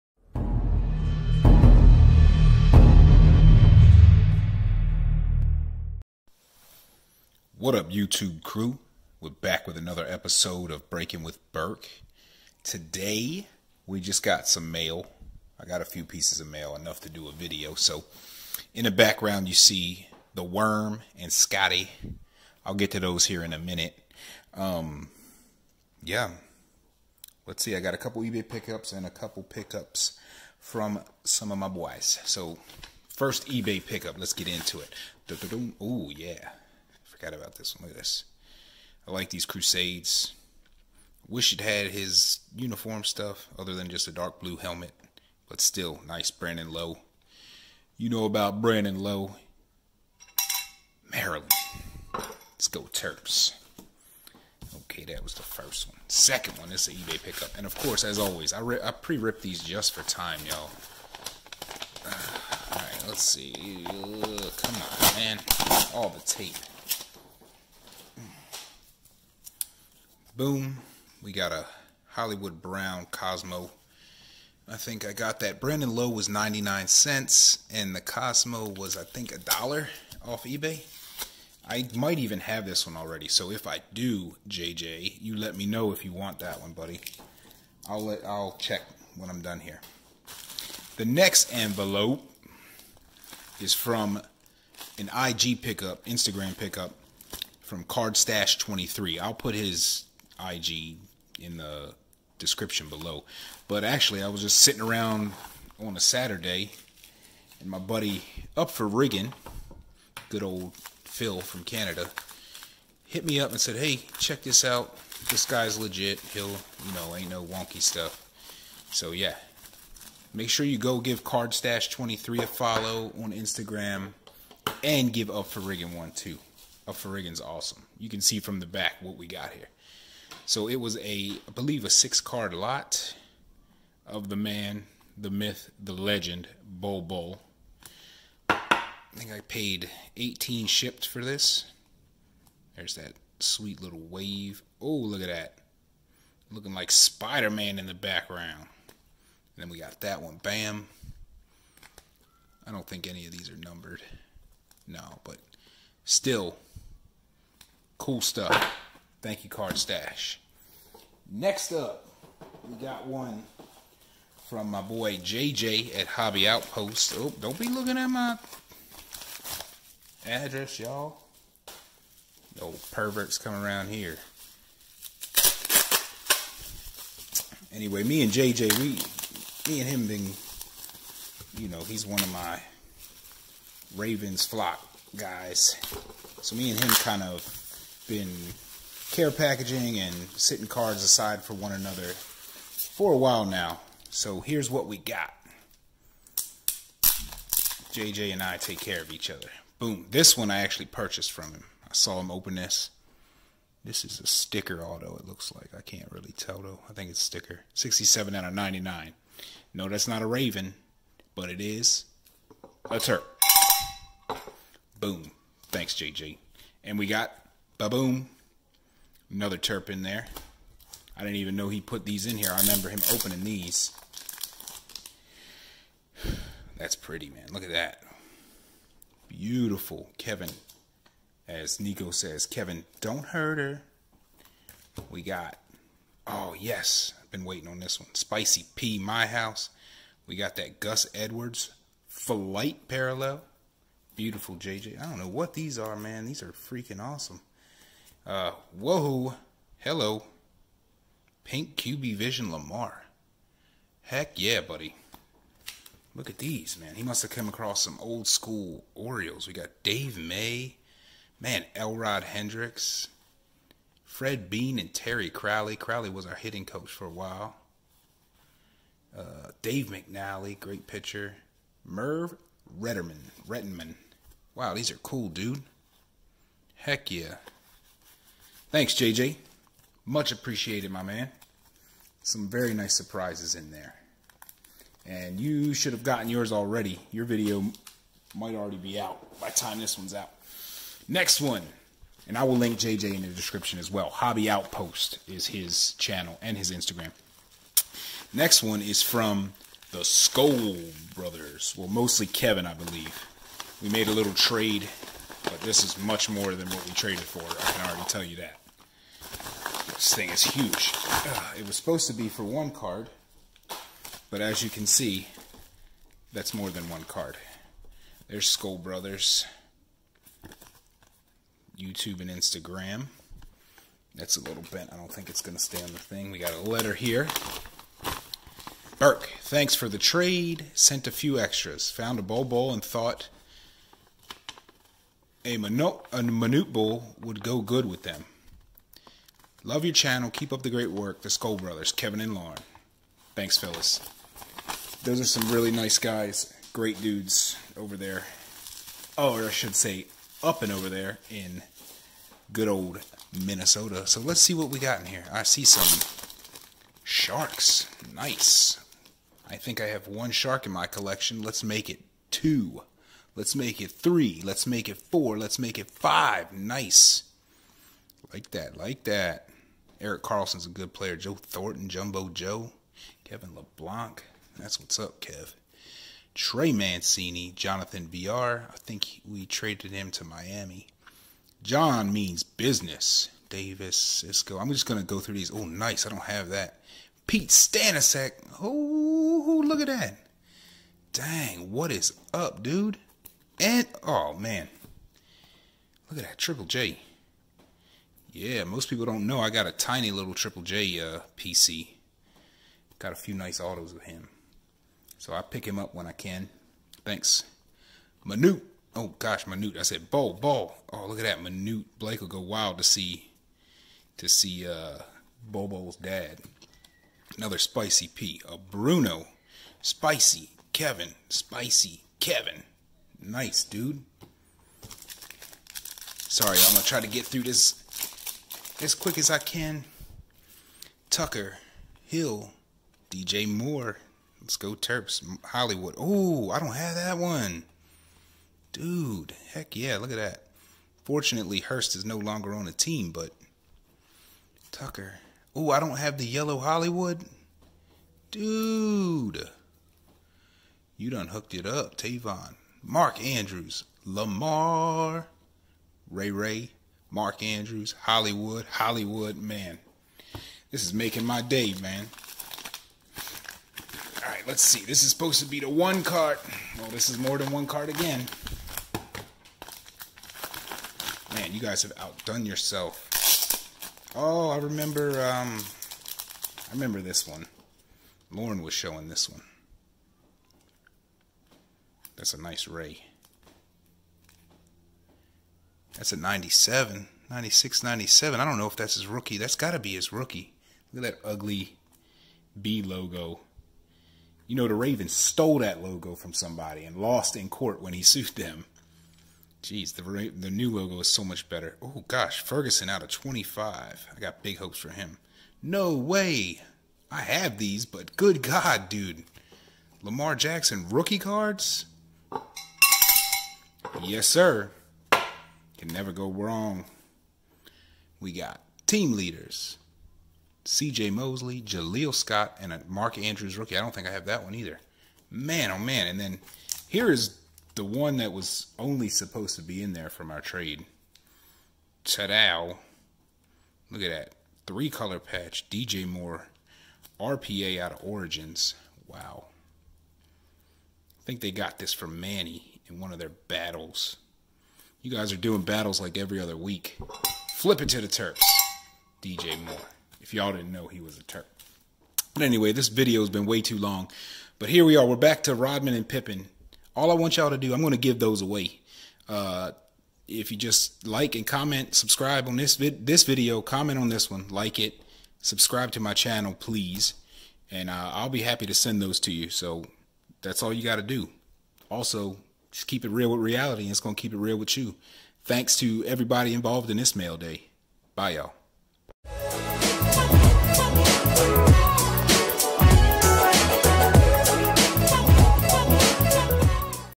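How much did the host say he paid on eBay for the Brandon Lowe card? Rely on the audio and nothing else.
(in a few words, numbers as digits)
99 cents.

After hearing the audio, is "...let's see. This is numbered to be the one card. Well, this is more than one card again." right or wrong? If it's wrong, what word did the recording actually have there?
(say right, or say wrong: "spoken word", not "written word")
wrong: "supposed", not "numbered".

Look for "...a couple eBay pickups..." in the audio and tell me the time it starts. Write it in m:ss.
0:27.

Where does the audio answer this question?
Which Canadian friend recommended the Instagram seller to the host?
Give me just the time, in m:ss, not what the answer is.
1:50.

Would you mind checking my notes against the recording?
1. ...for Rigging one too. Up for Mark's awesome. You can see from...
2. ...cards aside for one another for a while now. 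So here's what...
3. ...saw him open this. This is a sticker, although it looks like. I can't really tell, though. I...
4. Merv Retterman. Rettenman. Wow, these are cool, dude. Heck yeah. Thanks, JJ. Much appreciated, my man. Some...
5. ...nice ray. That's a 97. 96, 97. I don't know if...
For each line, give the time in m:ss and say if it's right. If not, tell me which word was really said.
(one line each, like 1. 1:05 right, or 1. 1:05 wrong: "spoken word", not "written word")
1. 2:05 wrong: "Rigging", not "Mark"
2. 3:10 right
3. 3:21 right
4. 4:31 right
5. 8:02 right.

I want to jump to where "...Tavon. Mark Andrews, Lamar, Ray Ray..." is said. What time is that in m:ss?
7:31.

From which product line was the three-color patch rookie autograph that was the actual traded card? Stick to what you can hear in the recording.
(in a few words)
Origins.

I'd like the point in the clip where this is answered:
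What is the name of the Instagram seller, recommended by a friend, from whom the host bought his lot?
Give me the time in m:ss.
1:37.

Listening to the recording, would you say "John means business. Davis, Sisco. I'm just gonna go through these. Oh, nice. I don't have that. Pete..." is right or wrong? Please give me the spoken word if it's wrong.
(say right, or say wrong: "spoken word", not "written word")
right.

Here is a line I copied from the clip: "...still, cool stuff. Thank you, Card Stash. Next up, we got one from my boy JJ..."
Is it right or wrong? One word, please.
right.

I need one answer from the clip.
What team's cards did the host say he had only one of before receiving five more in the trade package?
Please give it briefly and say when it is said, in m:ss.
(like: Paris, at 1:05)
Sharks, at 6:00.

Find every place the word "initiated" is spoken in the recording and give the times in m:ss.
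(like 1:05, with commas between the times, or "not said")
not said.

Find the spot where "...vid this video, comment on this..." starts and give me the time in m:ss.
9:22.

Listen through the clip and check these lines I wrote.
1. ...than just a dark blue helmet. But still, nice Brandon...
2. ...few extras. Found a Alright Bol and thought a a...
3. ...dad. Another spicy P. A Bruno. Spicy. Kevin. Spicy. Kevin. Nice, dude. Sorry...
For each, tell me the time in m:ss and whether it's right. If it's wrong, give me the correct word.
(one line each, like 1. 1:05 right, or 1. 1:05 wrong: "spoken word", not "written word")
1. 0:43 right
2. 5:31 wrong: "Bol", not "Alright"
3. 6:55 right.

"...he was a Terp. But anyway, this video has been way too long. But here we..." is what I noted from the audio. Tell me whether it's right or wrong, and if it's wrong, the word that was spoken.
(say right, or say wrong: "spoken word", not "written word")
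right.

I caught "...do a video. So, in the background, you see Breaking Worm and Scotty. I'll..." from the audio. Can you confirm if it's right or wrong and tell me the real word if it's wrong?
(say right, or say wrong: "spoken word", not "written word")
wrong: "The", not "Breaking".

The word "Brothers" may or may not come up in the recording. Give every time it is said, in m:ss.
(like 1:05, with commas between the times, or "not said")
5:01, 5:18, 5:41.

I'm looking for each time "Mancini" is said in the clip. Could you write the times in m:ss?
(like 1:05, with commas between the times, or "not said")
6:16.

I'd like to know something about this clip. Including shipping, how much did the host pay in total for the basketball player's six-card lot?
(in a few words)
18.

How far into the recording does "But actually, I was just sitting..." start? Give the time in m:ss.
1:43.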